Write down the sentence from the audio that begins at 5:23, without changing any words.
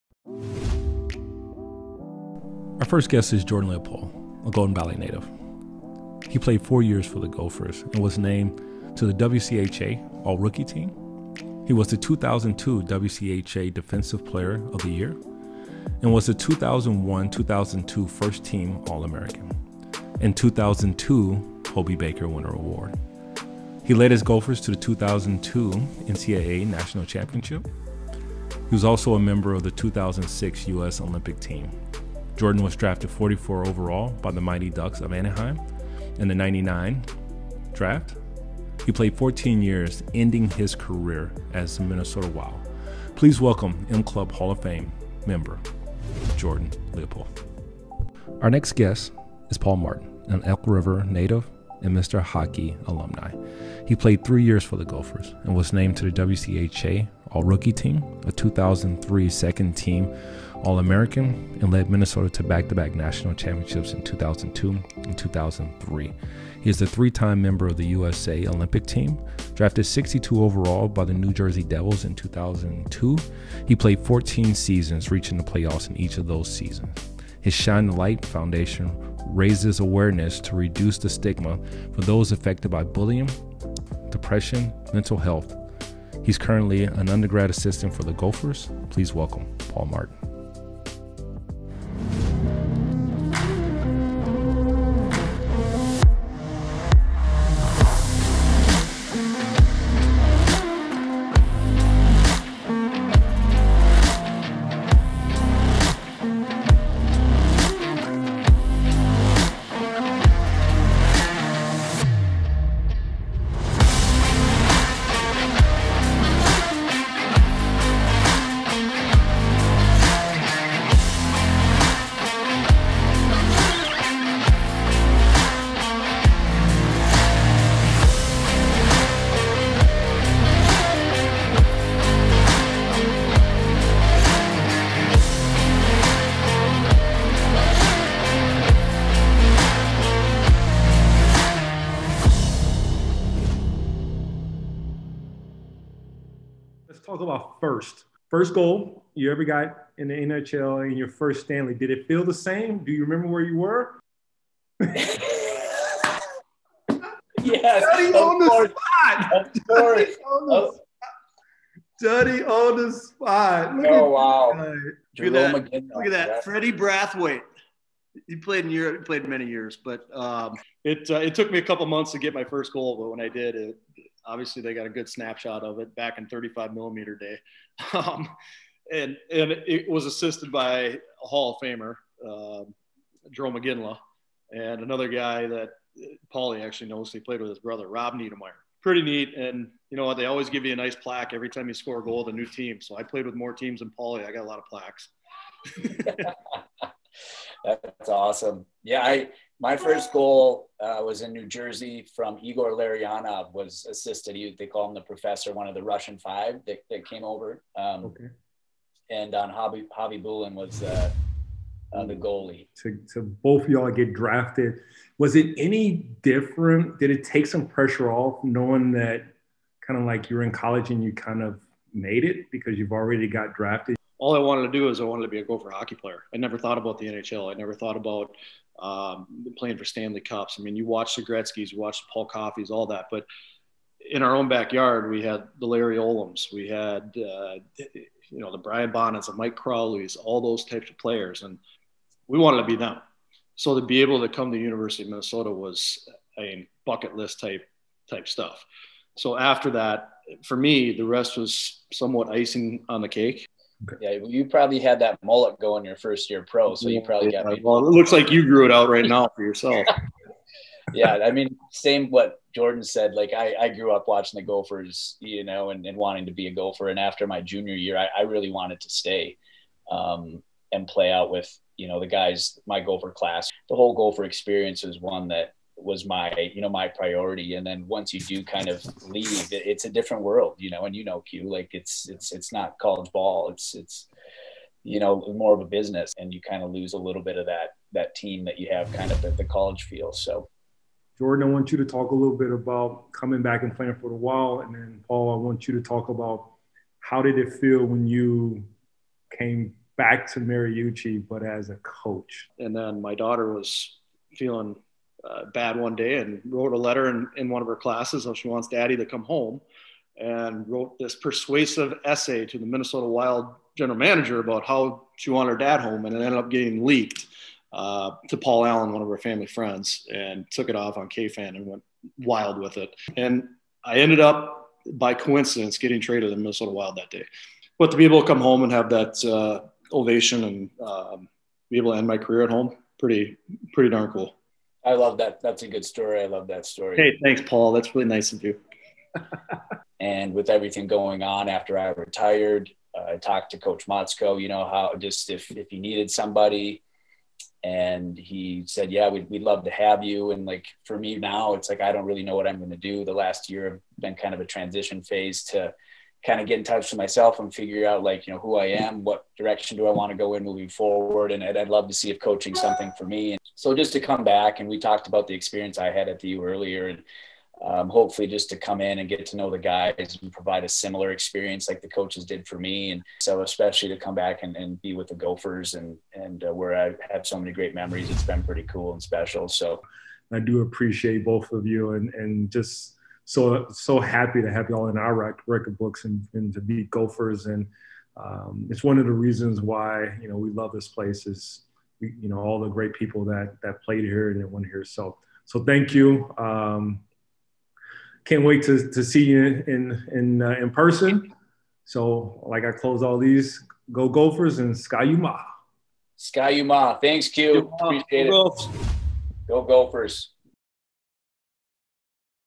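And I ended up by coincidence getting traded to the Minnesota Wild that day.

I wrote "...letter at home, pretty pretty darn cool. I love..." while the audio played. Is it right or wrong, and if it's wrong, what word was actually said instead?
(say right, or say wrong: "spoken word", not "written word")
wrong: "career", not "letter".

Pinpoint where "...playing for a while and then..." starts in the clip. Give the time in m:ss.
4:53.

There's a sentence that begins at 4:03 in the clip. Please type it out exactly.
So to be able to come to University of Minnesota was a bucket list type type stuff.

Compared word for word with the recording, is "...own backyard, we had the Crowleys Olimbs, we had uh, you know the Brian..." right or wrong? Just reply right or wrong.
wrong.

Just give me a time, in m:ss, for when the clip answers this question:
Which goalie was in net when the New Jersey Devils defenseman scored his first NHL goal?
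3:29.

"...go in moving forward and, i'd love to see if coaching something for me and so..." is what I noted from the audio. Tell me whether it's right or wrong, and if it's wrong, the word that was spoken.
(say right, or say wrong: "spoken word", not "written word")
right.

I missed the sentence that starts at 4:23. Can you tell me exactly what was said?
Like I, I grew up watching the Gophers, you know, and, and wanting to be a Gopher.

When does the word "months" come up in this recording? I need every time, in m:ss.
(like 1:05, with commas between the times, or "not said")
2:51.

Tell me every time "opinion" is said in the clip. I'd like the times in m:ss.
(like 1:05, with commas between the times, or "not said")
not said.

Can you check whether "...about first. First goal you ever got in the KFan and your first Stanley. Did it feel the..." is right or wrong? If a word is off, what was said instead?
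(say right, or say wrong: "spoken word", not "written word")
wrong: "NHL", not "KFan".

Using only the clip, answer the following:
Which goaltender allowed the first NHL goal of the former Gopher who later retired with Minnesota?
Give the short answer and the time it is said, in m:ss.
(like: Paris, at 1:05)
Freddie Brathwaite, at 2:46.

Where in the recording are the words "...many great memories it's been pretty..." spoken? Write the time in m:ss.
6:17.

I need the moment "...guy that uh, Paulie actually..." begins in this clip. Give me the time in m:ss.
3:05.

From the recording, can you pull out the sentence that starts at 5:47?
And he said, Yeah, we'd, we'd love to have you.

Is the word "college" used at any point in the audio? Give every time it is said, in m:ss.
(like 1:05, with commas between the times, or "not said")
3:40, 4:42, 4:49.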